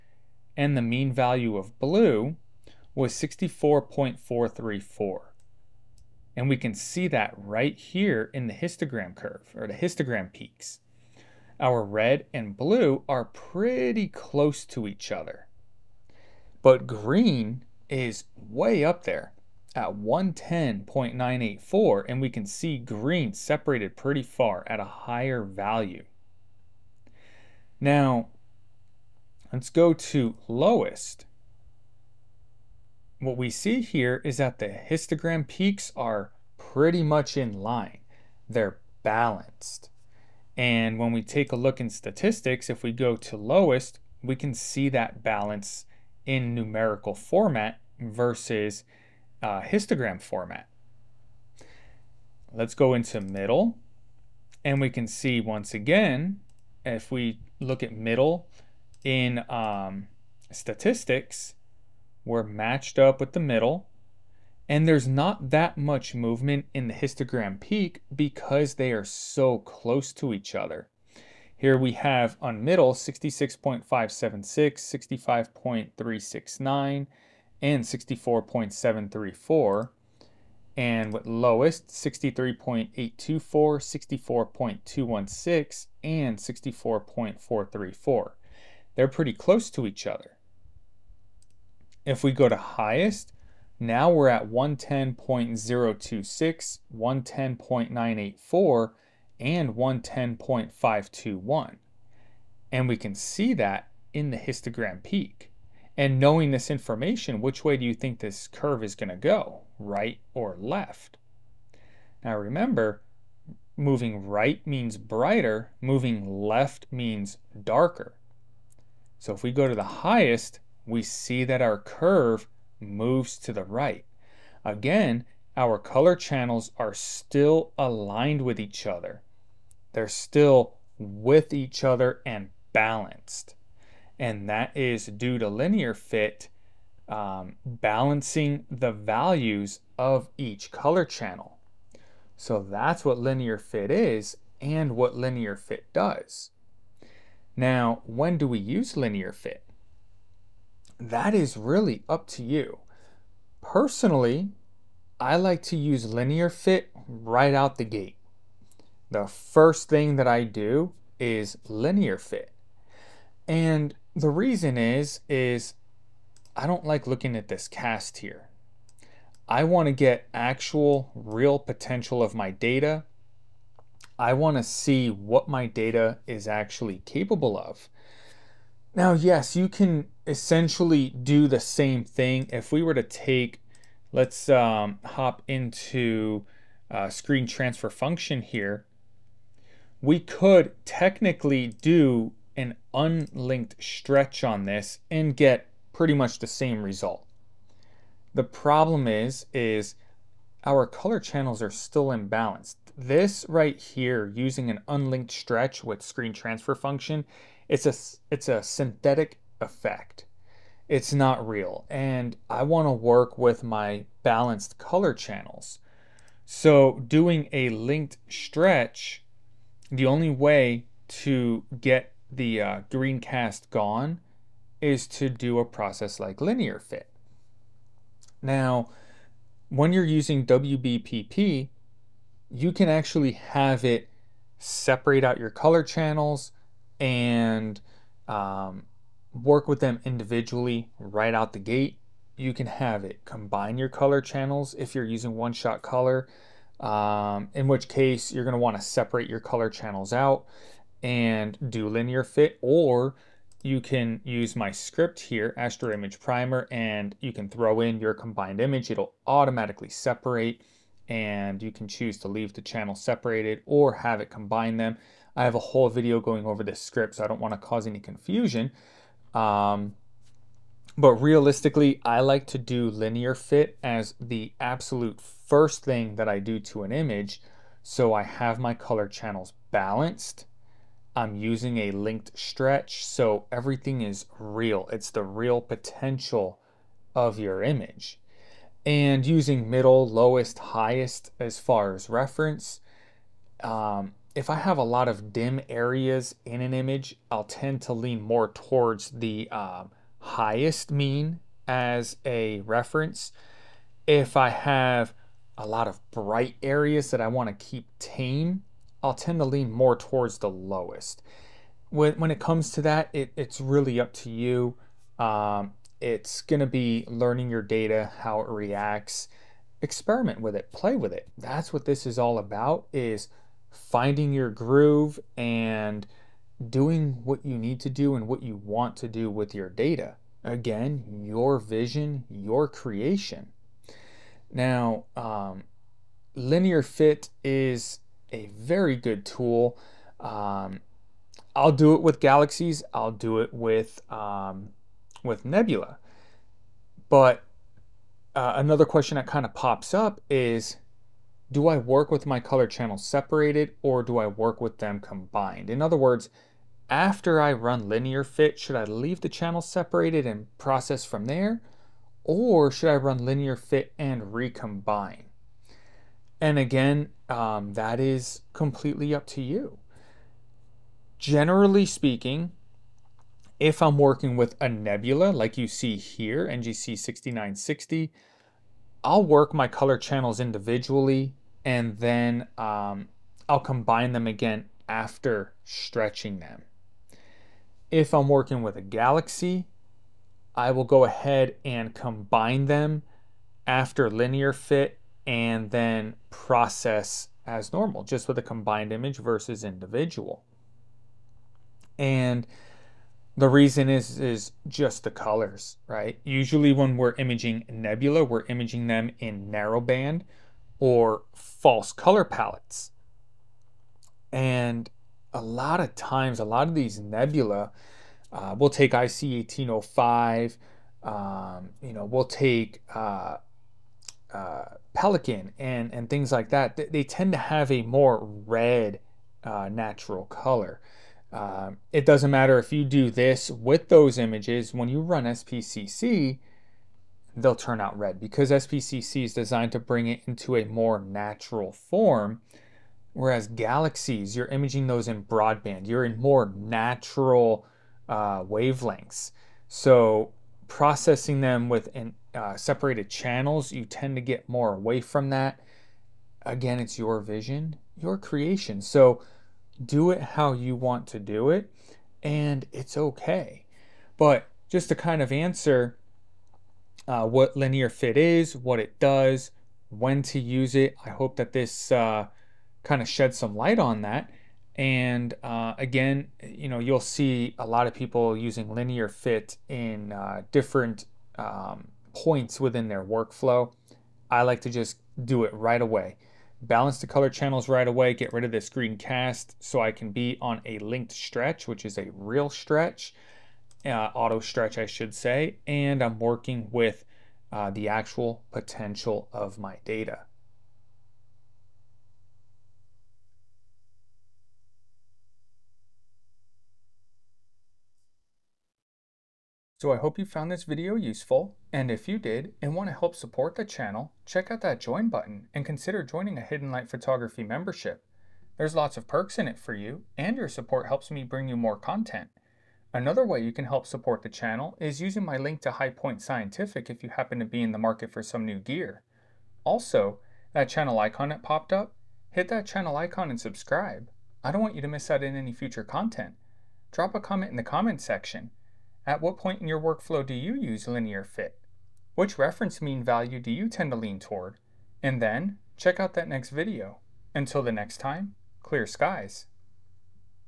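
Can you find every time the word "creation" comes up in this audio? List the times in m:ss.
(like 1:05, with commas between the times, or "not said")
5:32, 7:38.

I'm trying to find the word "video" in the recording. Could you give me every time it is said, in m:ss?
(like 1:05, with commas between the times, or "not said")
4:25, 8:30, 9:06.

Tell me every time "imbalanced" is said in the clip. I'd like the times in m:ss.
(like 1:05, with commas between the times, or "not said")
3:22.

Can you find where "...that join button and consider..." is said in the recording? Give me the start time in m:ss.
8:34.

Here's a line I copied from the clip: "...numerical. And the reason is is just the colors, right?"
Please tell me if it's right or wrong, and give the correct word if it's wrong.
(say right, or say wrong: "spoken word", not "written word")
wrong: "individual", not "numerical".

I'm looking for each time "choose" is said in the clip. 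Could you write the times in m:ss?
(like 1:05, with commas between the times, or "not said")
4:21.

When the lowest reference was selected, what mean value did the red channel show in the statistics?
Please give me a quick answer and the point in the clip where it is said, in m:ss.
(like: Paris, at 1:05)
63.824, at 1:21.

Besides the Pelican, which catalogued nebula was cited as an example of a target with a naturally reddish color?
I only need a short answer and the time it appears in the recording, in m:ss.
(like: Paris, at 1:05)
IC 1805, at 6:58.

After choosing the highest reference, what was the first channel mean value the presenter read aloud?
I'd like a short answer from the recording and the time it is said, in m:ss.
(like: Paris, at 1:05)
110.026, at 1:34.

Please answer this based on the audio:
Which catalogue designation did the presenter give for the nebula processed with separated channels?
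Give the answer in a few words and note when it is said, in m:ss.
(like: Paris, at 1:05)
NGC 6960, at 6:16.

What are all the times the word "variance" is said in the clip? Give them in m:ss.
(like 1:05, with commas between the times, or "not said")
not said.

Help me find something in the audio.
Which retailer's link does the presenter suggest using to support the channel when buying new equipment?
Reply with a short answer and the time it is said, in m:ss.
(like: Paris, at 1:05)
High Point Scientific, at 8:45.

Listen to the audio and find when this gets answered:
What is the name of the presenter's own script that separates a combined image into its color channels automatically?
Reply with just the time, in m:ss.
4:15.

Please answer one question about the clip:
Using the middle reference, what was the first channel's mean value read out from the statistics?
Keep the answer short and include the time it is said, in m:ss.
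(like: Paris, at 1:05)
66.576, at 1:12.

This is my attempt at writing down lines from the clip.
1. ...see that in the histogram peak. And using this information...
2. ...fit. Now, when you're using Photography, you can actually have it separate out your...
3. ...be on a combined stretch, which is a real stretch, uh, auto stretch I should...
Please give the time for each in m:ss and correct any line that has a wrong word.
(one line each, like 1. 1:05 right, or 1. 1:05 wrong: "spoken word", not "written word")
1. 1:43 wrong: "knowing", not "using"
2. 3:46 wrong: "WBPP", not "Photography"
3. 8:10 wrong: "linked", not "combined".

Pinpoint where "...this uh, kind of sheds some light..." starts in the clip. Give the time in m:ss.
7:51.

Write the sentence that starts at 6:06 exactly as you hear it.
And again, um, that is completely up to you.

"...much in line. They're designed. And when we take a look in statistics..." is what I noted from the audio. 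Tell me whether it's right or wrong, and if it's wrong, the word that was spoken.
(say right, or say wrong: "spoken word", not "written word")
wrong: "balanced", not "designed".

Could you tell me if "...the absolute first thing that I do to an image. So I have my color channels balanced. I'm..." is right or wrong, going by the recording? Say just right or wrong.
right.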